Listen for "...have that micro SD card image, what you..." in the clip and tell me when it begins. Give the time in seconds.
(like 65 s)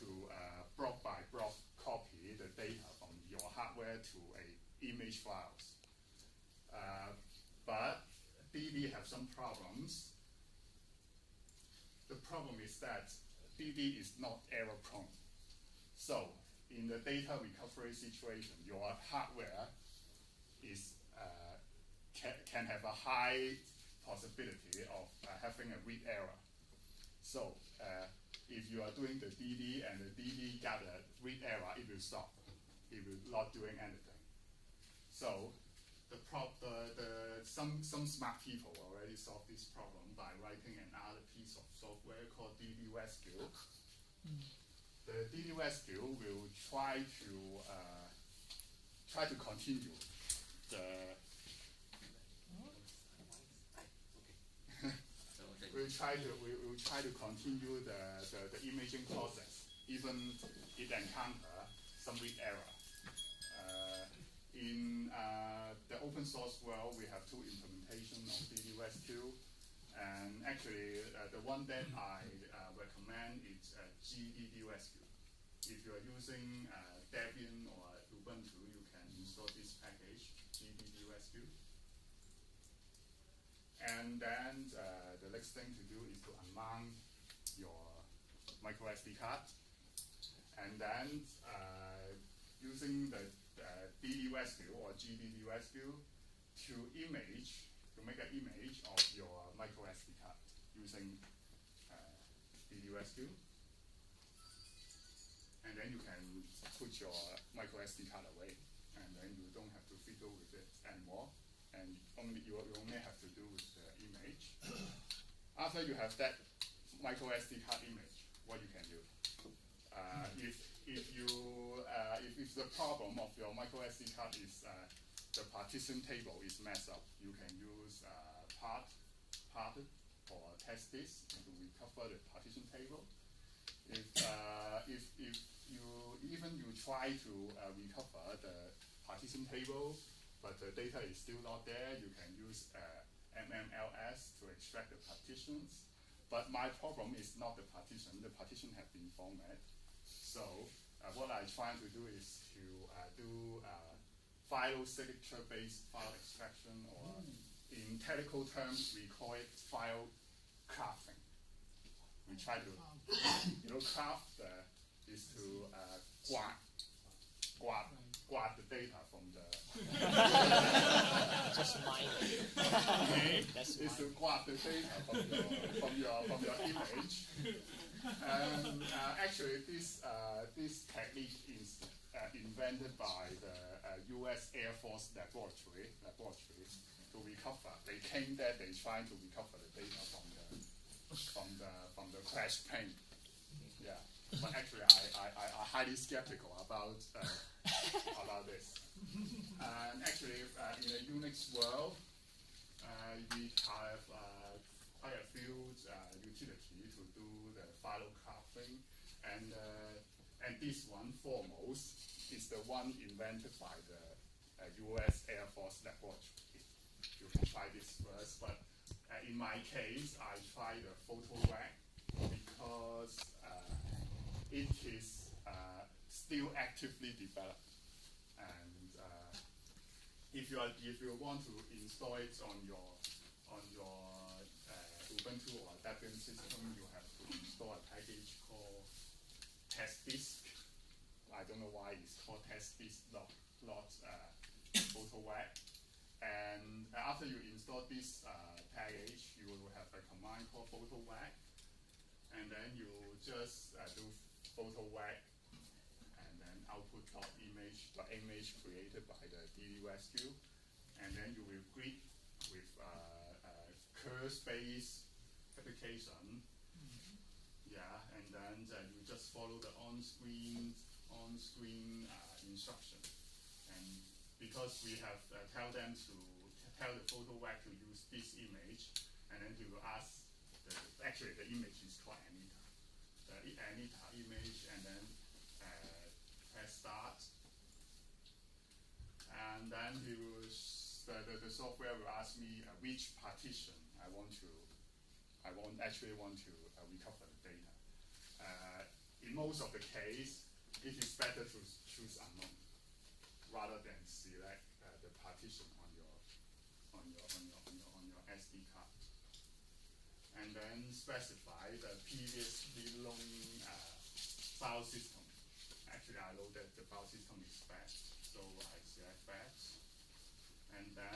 115 s.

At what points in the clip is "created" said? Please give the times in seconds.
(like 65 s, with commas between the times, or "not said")
258 s.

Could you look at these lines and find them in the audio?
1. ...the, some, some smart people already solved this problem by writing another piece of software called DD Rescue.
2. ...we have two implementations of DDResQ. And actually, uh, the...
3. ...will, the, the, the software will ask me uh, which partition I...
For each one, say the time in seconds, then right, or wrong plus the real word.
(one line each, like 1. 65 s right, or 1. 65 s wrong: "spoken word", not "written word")
1. 36 s right
2. 66 s right
3. 290 s right.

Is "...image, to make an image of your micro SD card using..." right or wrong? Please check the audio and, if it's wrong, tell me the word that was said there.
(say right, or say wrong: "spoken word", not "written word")
right.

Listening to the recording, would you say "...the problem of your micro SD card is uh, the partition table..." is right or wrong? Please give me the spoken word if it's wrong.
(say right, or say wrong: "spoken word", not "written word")
right.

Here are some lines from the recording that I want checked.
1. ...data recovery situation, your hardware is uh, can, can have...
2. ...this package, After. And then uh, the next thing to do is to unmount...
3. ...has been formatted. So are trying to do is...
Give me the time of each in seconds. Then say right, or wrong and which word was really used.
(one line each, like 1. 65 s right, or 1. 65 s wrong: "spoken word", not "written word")
1. 16 s right
2. 79 s wrong: "GDDResQ", not "After"
3. 148 s right.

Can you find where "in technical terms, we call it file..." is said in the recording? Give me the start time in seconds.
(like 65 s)
157 s.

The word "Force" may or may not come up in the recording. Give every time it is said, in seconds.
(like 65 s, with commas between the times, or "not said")
184 s, 215 s.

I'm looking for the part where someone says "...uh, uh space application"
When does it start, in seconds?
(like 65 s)
262 s.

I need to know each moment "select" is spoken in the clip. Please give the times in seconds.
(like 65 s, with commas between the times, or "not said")
304 s, 318 s.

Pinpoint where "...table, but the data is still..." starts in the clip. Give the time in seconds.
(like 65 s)
139 s.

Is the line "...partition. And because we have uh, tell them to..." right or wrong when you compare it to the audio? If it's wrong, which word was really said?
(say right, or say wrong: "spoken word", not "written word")
wrong: "instruction", not "partition".